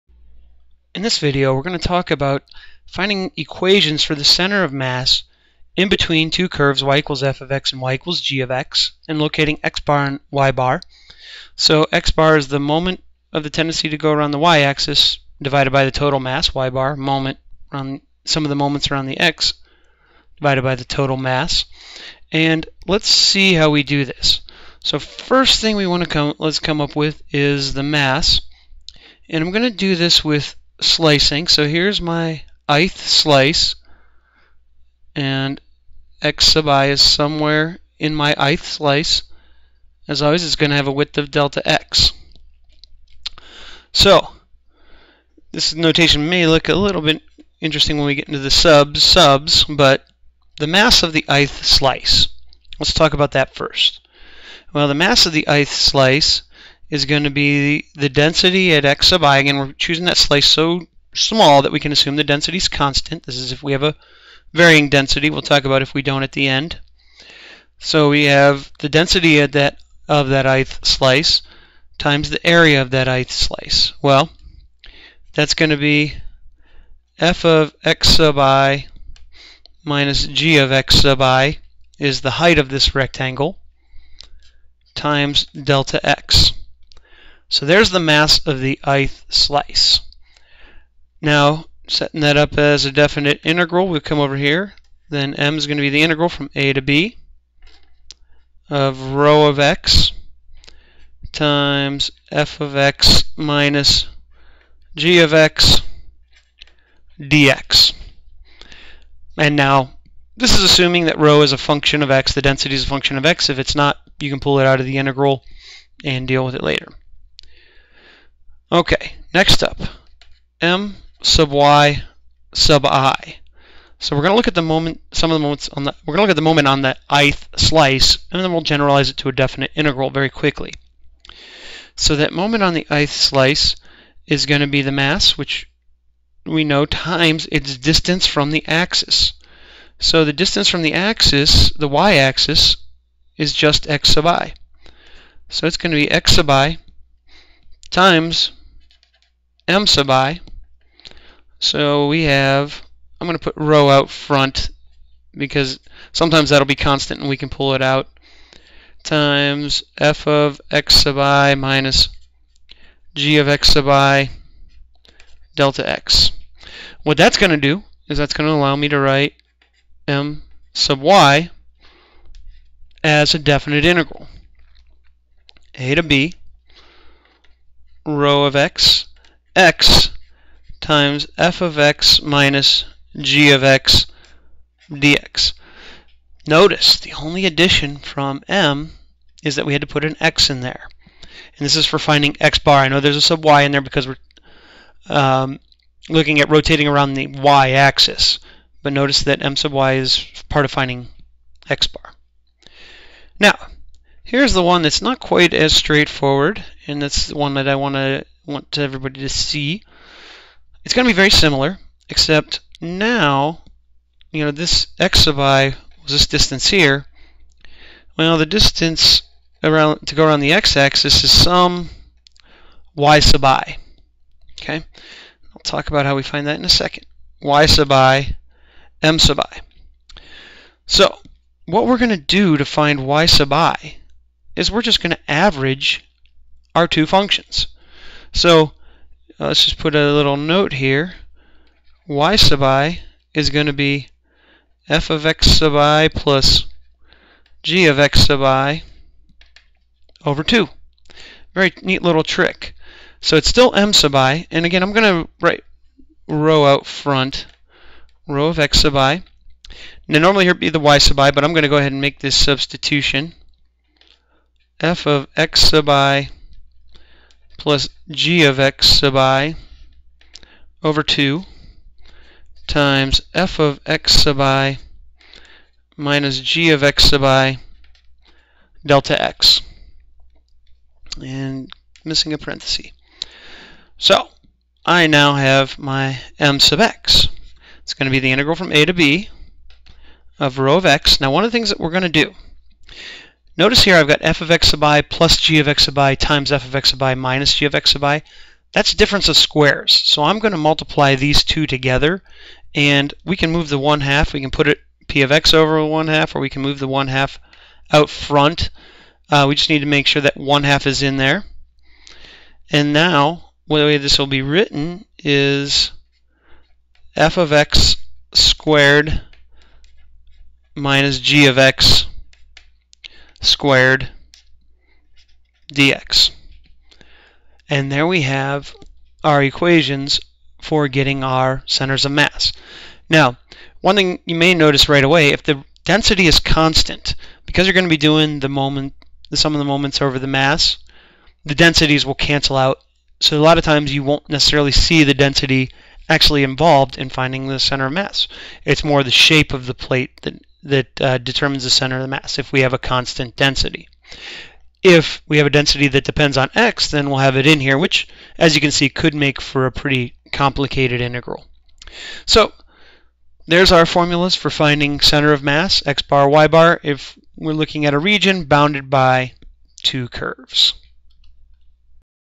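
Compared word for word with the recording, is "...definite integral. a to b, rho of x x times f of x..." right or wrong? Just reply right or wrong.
right.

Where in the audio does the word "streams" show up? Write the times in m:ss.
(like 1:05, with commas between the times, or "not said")
not said.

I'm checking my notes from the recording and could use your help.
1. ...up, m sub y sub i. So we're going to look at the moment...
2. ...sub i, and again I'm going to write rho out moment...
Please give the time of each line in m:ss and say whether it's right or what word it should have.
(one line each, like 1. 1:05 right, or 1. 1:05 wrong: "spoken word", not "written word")
1. 1:59 right
2. 4:13 wrong: "front", not "moment".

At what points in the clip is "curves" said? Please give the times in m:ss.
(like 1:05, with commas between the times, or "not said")
0:06, 6:10.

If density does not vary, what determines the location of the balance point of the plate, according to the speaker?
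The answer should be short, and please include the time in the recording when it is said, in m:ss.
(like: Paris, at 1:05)
the shape of the plate, at 5:49.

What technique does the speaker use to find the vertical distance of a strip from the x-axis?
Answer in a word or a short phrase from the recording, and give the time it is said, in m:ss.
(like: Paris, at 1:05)
average our two functions, at 3:55.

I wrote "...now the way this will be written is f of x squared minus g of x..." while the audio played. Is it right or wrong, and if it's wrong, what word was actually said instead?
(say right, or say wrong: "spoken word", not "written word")
right.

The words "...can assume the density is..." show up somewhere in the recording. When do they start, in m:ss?
1:01.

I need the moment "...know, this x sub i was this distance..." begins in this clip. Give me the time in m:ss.
3:34.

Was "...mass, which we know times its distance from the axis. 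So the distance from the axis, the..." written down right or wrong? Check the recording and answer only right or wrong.
right.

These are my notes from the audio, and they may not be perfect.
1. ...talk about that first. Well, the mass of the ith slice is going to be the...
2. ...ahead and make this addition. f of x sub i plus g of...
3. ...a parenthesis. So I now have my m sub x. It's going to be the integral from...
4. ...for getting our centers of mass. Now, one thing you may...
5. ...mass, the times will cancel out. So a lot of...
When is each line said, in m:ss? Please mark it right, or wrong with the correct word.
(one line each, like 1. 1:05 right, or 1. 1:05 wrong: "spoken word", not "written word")
1. 0:52 right
2. 4:21 wrong: "substitution", not "addition"
3. 4:42 right
4. 5:30 right
5. 5:40 wrong: "densities", not "times".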